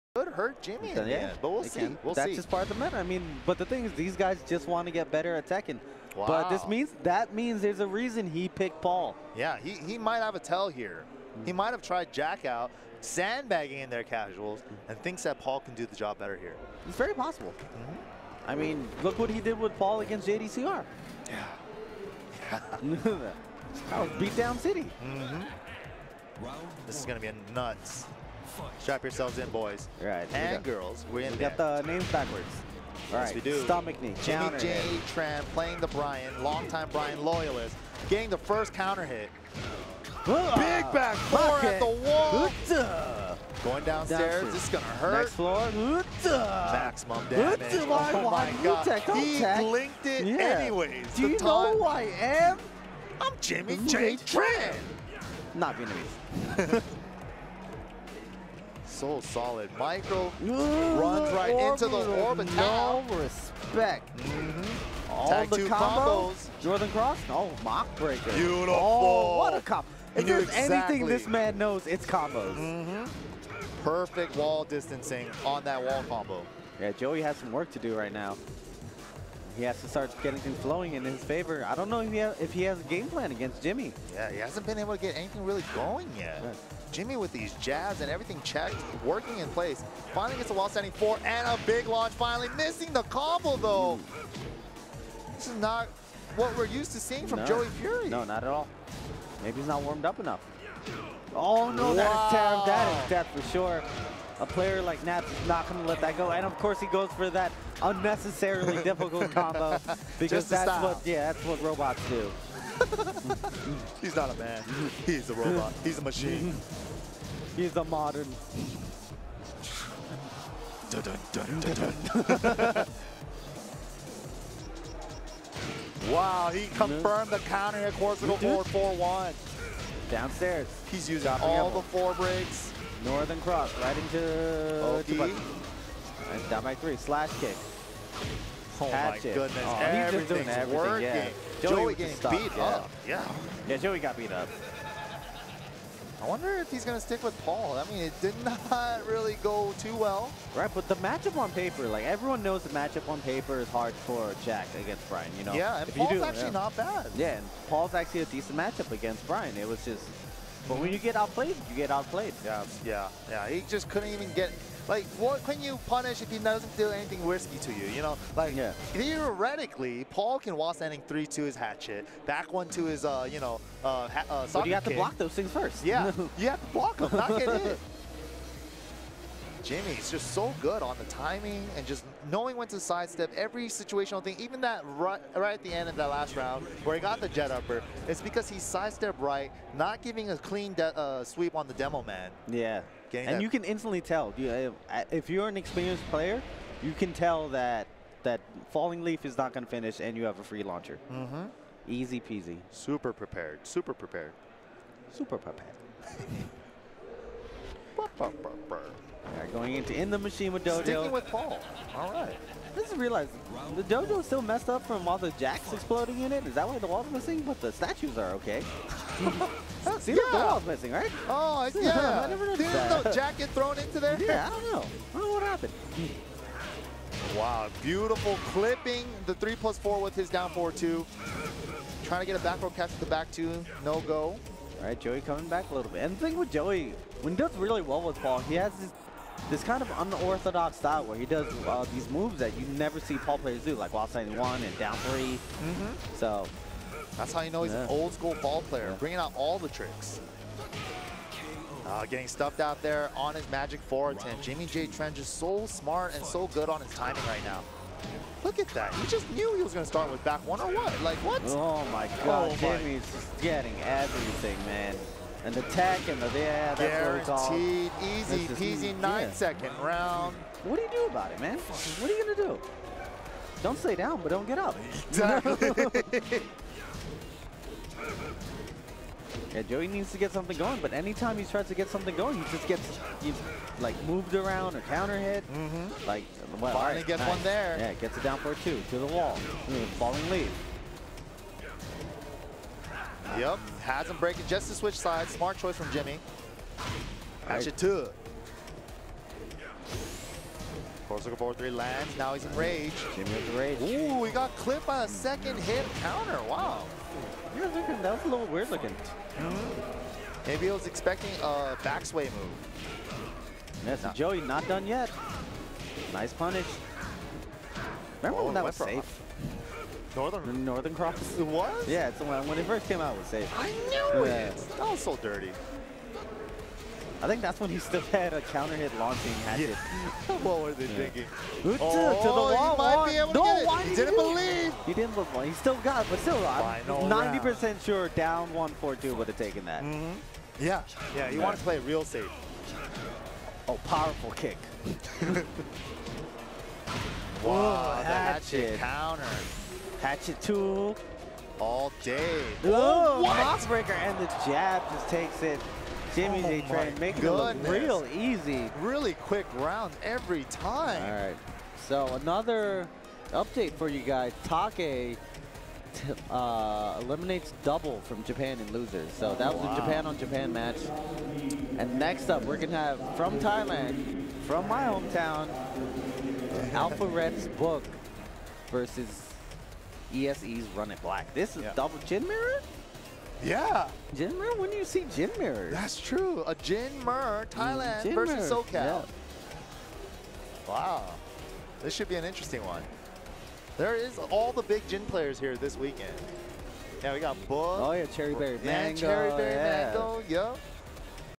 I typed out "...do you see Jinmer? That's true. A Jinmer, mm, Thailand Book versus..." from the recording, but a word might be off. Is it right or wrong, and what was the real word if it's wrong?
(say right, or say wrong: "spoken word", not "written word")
wrong: "Jin", not "Book".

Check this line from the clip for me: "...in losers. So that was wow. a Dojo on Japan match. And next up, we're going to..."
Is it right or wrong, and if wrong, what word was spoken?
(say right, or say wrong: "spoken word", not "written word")
wrong: "Japan", not "Dojo".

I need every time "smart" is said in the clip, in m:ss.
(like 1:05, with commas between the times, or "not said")
4:15, 4:55.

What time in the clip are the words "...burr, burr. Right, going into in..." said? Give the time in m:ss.
3:28.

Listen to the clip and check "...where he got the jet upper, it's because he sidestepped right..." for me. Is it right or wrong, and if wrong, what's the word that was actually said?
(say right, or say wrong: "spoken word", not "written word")
right.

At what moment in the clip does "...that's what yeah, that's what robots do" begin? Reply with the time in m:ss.
1:50.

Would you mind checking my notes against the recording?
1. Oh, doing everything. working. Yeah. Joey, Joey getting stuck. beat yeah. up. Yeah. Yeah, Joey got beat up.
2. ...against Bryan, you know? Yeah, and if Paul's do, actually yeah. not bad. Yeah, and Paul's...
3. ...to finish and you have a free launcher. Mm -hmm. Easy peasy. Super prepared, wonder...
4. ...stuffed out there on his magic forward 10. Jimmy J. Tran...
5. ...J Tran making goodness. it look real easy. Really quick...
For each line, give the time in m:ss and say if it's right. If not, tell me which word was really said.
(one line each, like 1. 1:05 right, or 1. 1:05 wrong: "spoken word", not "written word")
1. 2:19 right
2. 2:34 right
3. 3:19 wrong: "super", not "wonder"
4. 4:12 right
5. 5:56 right.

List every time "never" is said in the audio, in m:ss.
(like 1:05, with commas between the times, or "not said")
3:42, 4:02.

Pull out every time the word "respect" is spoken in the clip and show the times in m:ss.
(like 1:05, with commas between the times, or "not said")
1:03.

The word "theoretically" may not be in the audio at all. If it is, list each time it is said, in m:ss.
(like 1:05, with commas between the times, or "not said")
2:48.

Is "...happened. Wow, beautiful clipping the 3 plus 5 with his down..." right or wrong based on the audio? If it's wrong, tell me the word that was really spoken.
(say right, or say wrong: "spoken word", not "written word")
wrong: "4", not "5".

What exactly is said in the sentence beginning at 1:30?
Finally gets a wall standing four and a big launch finally.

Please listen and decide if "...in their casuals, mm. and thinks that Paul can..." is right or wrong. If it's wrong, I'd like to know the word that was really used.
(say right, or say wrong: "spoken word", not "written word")
right.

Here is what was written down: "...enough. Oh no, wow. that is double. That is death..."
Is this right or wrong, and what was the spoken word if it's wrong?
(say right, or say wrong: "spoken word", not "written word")
wrong: "terrible", not "double".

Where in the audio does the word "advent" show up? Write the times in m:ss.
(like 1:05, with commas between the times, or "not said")
not said.